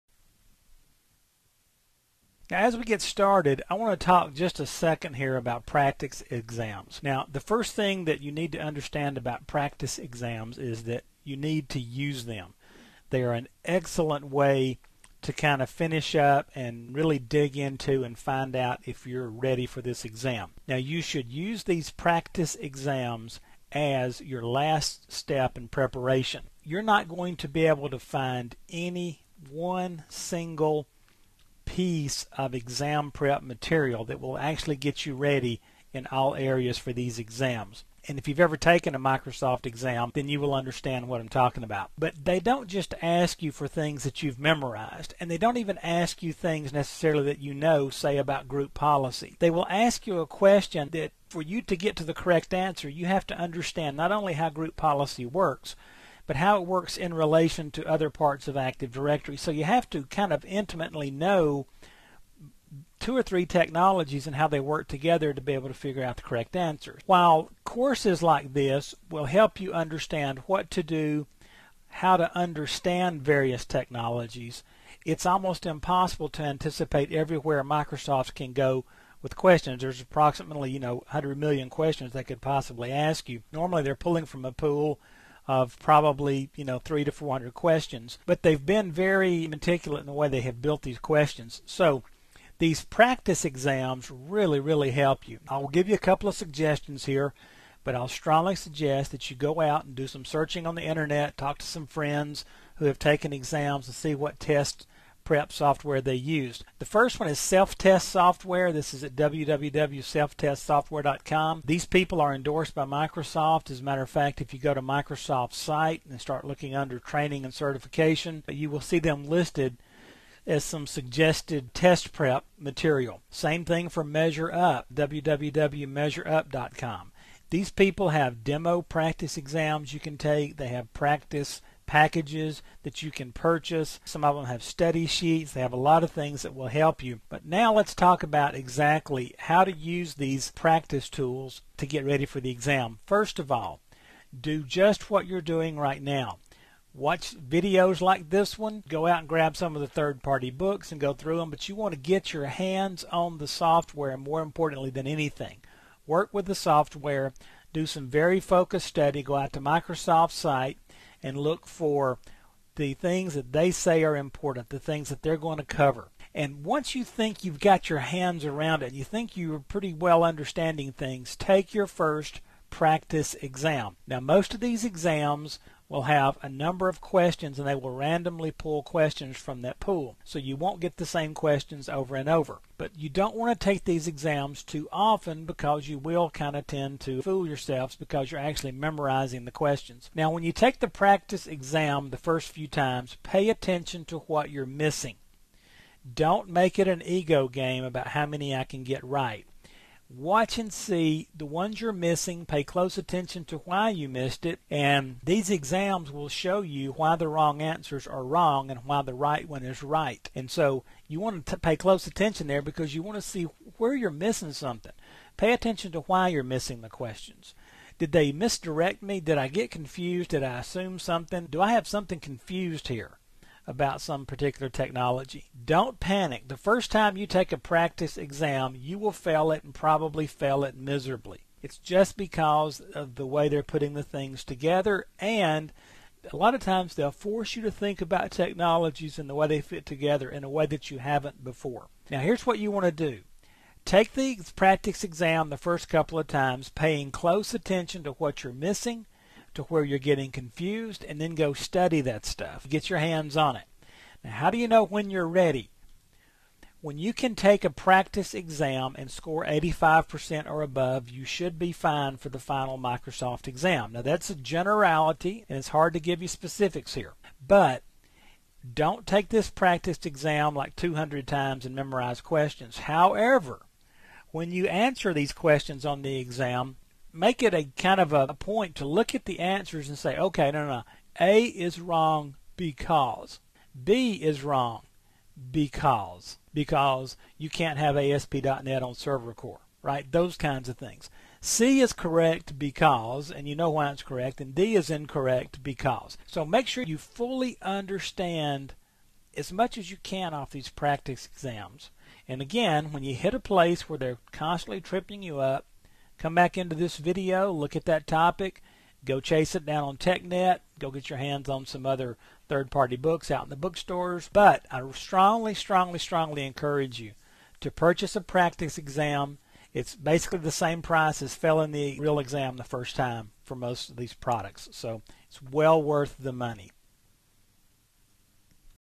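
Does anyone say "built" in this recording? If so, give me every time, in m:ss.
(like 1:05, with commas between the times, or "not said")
1:30.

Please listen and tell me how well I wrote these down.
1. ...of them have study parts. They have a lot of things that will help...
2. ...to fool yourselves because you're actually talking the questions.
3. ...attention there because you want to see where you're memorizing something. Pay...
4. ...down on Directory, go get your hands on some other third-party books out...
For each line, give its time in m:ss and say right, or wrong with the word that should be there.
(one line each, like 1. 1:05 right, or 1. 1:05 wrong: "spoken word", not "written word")
1. 2:14 wrong: "sheets", not "parts"
2. 3:07 wrong: "memorizing", not "talking"
3. 3:32 wrong: "missing", not "memorizing"
4. 5:09 wrong: "TechNet", not "Directory".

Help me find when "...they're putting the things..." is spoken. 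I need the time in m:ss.
3:53.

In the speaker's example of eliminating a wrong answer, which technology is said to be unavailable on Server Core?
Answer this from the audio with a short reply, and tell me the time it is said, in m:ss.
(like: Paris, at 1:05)
ASP.NET, at 4:47.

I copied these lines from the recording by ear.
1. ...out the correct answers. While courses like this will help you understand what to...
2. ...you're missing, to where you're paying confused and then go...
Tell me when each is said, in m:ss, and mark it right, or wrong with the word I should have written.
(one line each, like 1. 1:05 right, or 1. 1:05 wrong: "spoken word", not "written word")
1. 1:06 right
2. 4:08 wrong: "getting", not "paying".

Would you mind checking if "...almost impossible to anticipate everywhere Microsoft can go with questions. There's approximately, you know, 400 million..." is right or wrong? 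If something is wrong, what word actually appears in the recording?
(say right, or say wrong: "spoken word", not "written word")
wrong: "100", not "400".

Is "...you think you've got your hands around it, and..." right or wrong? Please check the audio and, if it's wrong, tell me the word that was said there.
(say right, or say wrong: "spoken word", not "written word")
right.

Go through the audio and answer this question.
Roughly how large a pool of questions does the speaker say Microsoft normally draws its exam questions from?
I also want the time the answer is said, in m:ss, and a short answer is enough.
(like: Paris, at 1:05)
300 to 400, at 1:26.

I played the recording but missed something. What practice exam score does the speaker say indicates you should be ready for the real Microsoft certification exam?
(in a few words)
85%.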